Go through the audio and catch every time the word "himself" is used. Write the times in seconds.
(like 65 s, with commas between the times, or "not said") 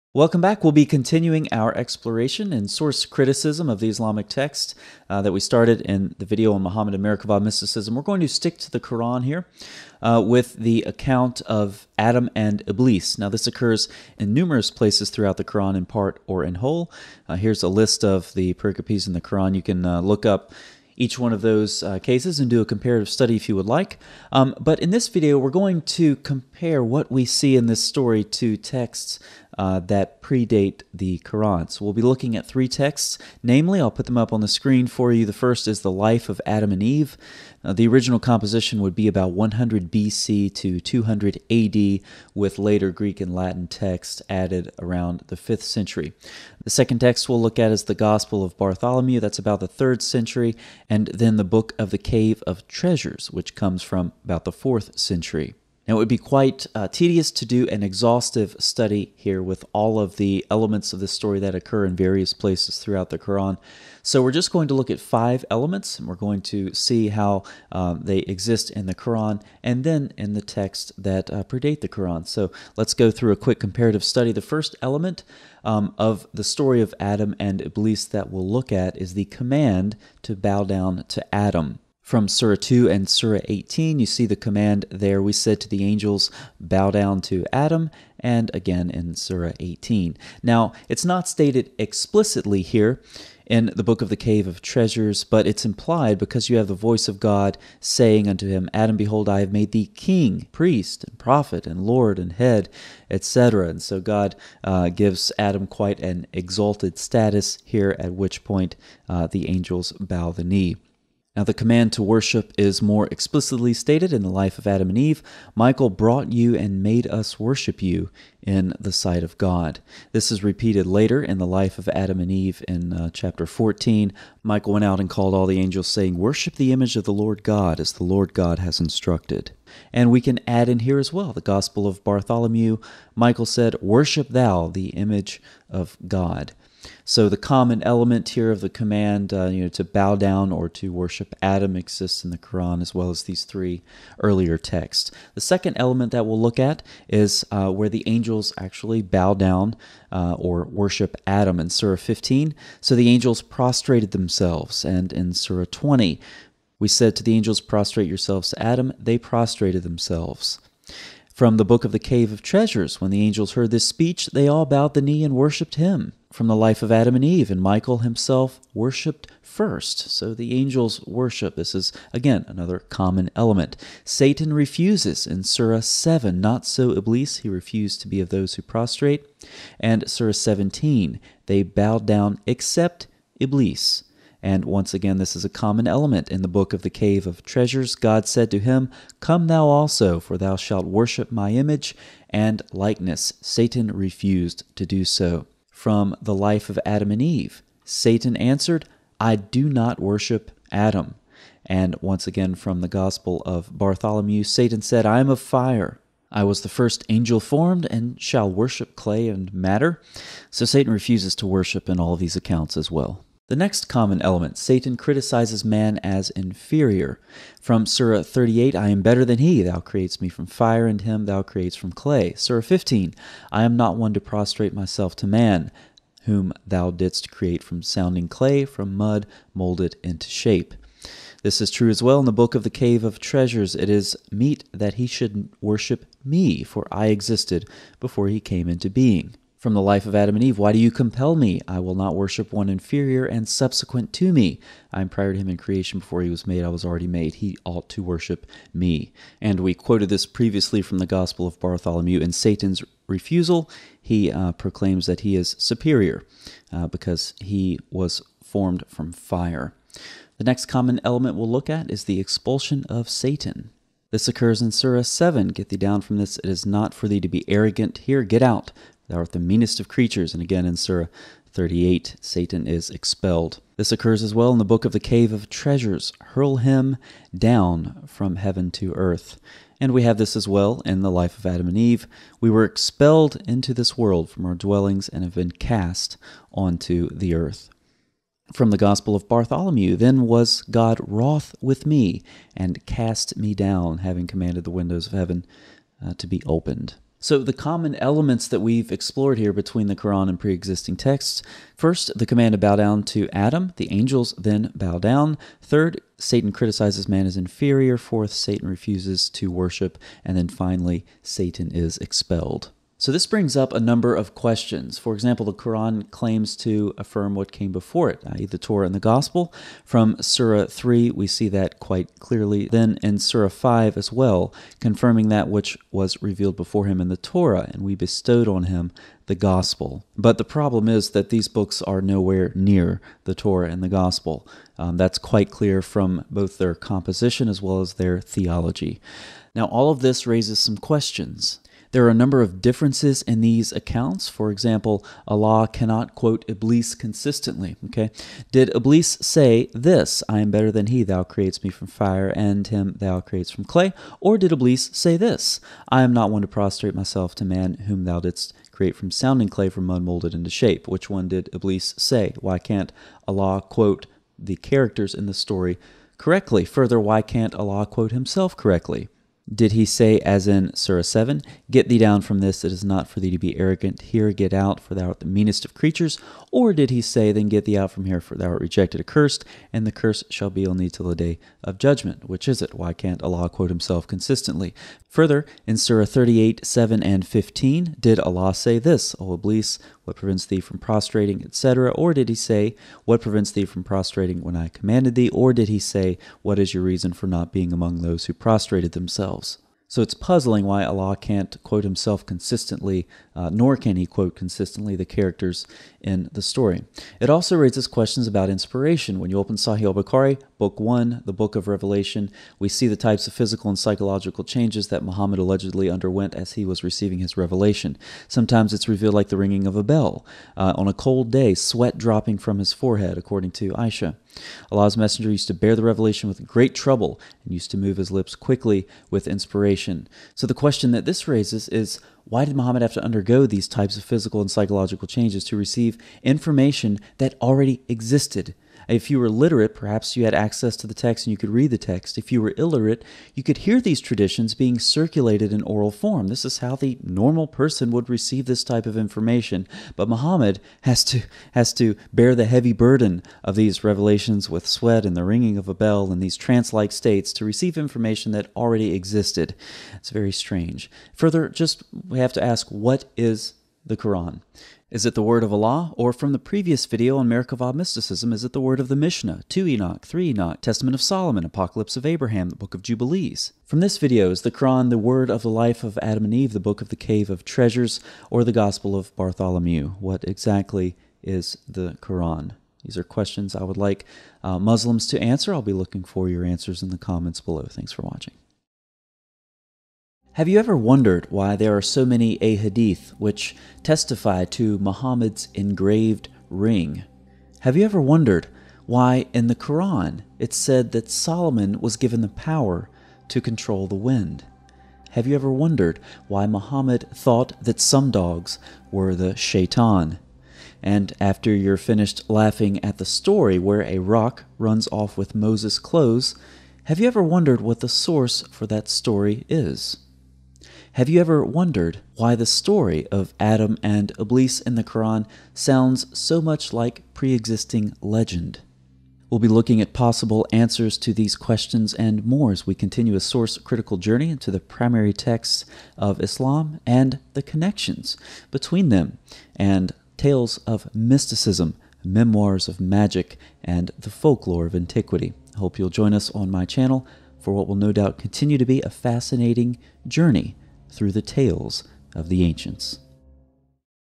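167 s, 368 s, 383 s, 401 s.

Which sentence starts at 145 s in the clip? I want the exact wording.
The second element that we'll look at is uh, where the angels actually bow down uh, or worship Adam in Surah 15.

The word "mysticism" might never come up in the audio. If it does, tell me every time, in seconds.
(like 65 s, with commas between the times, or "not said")
7 s, 467 s, 540 s.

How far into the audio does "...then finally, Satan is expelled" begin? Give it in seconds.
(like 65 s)
310 s.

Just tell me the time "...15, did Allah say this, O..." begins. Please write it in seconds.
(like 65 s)
387 s.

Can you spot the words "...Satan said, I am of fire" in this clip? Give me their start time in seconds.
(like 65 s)
204 s.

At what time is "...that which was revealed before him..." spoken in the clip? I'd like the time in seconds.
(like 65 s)
325 s.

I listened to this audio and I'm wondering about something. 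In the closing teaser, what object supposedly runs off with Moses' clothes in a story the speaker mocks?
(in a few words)
a rock.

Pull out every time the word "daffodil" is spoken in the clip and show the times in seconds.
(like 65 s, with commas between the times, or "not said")
not said.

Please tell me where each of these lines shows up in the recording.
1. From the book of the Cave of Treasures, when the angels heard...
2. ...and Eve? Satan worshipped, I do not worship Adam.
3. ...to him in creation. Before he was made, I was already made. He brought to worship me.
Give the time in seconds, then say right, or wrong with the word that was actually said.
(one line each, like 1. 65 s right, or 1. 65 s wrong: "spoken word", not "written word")
1. 161 s right
2. 197 s wrong: "answered", not "worshipped"
3. 245 s wrong: "ought", not "brought".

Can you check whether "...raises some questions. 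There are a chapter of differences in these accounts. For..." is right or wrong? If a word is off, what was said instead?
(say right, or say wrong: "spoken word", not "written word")
wrong: "number", not "chapter".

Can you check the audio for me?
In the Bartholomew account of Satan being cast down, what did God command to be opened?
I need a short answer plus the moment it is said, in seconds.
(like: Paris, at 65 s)
the windows of heaven, at 294 s.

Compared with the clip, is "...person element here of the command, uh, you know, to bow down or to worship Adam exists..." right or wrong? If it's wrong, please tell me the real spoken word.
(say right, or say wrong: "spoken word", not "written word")
wrong: "common", not "person".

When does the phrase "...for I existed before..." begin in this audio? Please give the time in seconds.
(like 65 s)
236 s.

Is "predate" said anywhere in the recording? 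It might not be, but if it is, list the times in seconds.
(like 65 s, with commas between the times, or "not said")
30 s, 71 s.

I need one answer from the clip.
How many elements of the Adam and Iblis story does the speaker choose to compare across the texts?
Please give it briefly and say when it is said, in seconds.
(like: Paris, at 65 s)
5, at 64 s.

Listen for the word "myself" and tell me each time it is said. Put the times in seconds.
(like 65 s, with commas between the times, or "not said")
224 s, 356 s.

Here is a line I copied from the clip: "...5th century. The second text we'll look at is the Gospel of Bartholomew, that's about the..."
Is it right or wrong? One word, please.
right.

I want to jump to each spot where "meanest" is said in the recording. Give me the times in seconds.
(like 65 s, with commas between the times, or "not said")
269 s, 375 s.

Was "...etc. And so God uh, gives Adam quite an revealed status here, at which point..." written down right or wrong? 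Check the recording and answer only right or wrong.
wrong.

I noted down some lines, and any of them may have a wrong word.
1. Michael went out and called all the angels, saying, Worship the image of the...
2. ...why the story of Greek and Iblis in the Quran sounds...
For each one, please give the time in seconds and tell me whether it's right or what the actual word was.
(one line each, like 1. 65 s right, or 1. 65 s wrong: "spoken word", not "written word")
1. 124 s right
2. 522 s wrong: "Adam", not "Greek".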